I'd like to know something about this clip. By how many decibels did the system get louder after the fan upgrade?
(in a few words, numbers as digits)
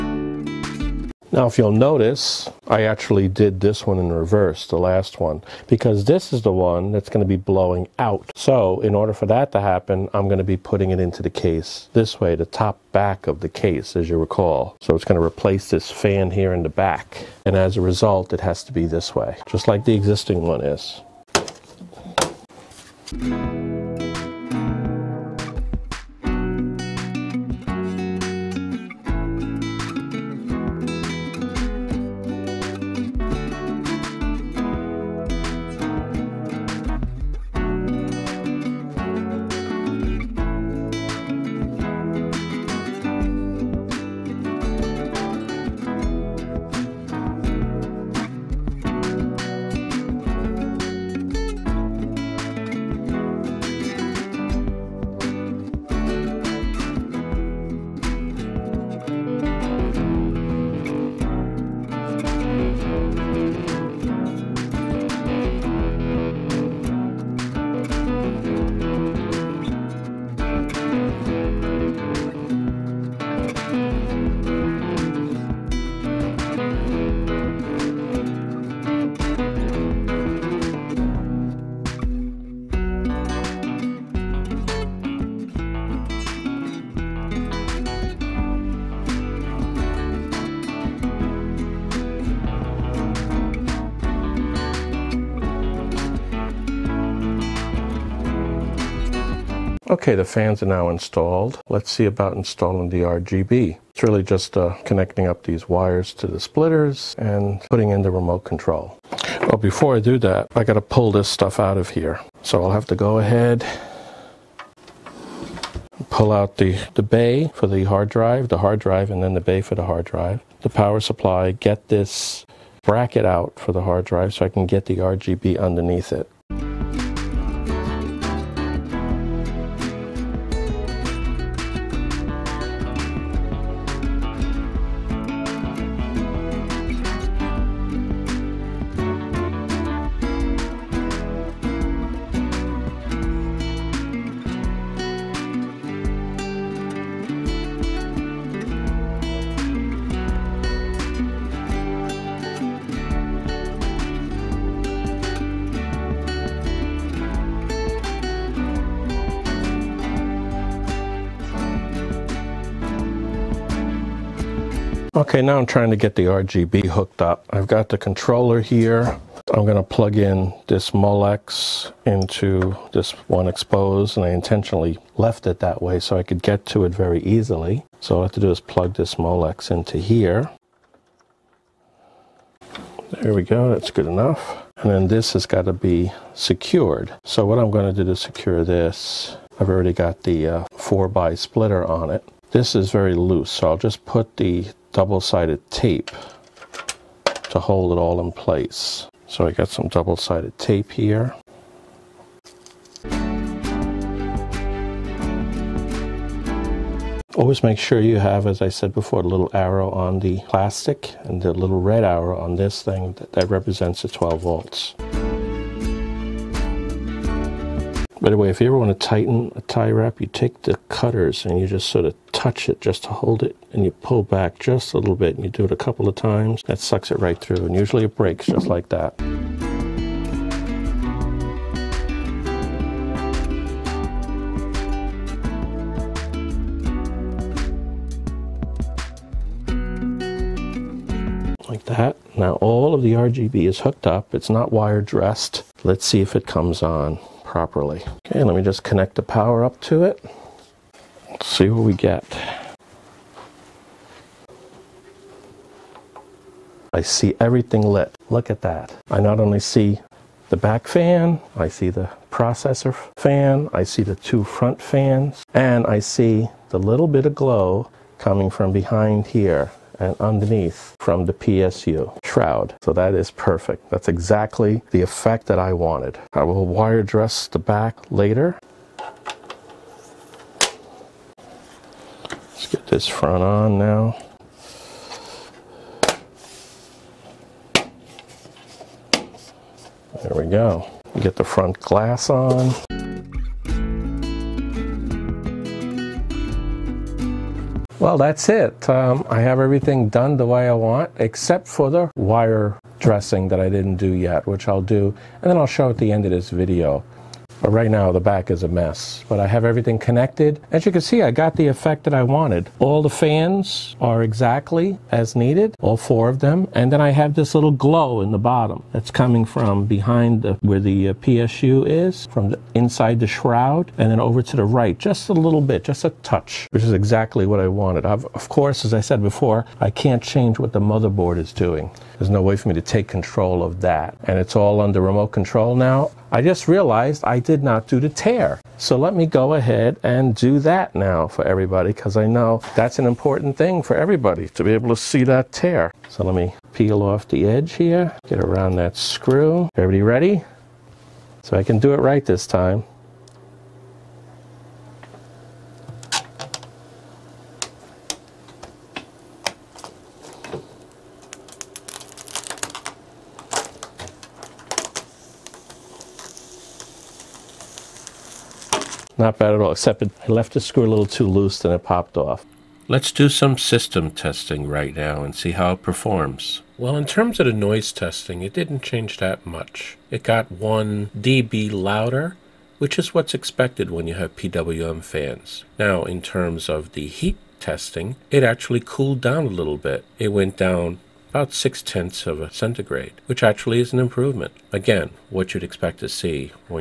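1 dB.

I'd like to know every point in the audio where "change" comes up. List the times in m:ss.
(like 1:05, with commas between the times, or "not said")
5:30, 6:18.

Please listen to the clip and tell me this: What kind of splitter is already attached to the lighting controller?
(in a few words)
4-way splitter.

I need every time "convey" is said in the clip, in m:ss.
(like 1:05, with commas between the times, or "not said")
not said.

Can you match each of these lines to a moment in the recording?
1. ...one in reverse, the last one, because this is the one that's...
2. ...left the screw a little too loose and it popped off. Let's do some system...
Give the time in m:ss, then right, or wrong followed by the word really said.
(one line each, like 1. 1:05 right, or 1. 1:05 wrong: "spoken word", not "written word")
1. 0:03 right
2. 6:10 right.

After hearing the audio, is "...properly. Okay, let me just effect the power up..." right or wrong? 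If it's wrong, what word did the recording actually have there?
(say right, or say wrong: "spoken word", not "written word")
wrong: "connect", not "effect".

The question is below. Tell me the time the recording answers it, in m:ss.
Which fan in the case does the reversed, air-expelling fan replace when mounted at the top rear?
0:15.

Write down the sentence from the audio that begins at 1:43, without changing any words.
It's really just uh, connecting up these wires to the splitters and putting in the remote control.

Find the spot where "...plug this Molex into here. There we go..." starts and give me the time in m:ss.
2:58.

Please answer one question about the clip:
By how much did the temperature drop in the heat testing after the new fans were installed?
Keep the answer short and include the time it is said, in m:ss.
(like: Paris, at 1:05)
0.6 degrees Celsius, at 6:31.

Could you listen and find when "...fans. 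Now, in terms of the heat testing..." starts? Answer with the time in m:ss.
6:25.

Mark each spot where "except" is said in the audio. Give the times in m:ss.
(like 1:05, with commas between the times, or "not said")
5:01, 6:09.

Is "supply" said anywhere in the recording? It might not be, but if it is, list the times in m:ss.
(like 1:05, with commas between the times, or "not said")
2:01.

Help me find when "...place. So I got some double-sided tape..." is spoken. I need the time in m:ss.
3:18.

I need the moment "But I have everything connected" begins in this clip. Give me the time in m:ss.
5:09.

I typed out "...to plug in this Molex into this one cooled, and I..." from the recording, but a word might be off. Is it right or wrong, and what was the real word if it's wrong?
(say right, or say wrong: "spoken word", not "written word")
wrong: "exposed", not "cooled".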